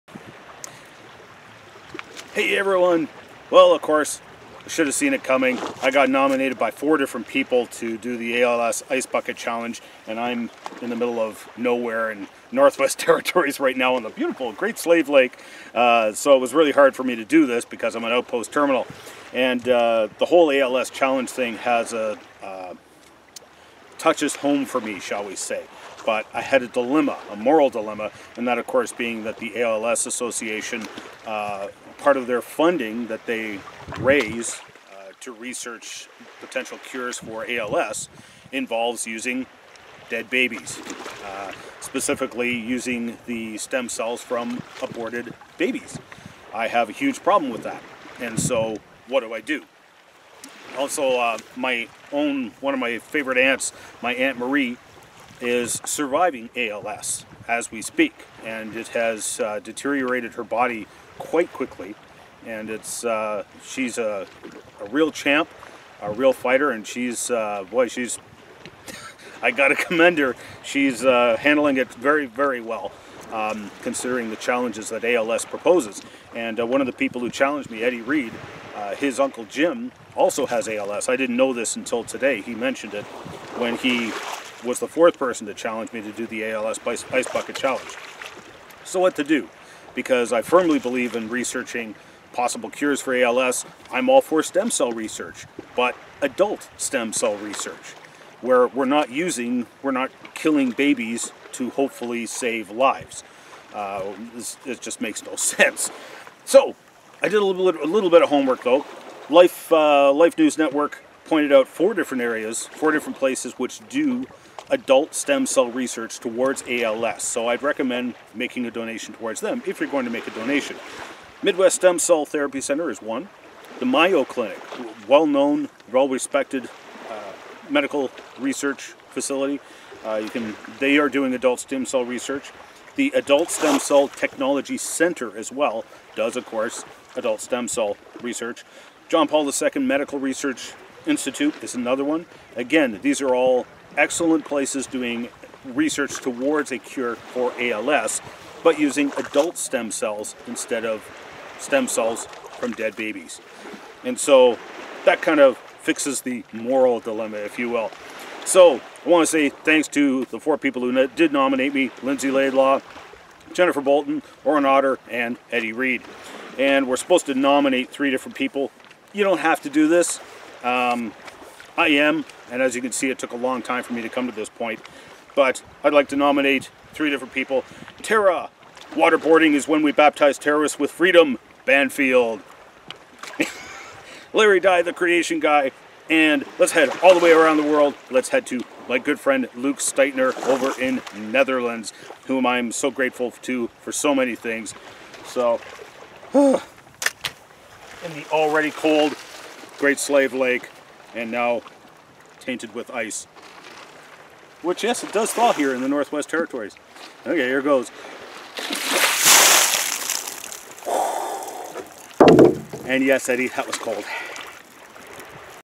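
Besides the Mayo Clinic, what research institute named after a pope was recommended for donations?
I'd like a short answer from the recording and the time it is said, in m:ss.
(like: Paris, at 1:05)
John Paul II Medical Research Institute, at 2:19.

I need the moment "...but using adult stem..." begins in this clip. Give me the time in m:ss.
2:28.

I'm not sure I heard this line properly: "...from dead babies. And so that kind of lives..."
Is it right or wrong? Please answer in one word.
wrong.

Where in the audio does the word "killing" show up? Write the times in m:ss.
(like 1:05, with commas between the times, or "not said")
1:40.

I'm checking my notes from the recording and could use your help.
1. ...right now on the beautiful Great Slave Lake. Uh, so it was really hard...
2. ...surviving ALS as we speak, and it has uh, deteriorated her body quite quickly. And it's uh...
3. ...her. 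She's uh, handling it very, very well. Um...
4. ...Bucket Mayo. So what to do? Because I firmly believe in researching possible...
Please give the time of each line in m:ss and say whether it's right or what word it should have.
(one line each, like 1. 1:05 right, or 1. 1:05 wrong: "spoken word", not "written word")
1. 0:13 right
2. 0:55 right
3. 1:10 right
4. 1:27 wrong: "Challenge", not "Mayo".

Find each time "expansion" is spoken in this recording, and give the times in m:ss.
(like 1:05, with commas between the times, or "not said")
not said.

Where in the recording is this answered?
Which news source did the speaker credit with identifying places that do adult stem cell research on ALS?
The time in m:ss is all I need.
1:50.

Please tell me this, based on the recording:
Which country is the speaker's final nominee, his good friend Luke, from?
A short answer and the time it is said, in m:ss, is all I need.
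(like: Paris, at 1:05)
Netherlands, at 3:11.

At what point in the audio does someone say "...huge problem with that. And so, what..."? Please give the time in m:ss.
0:46.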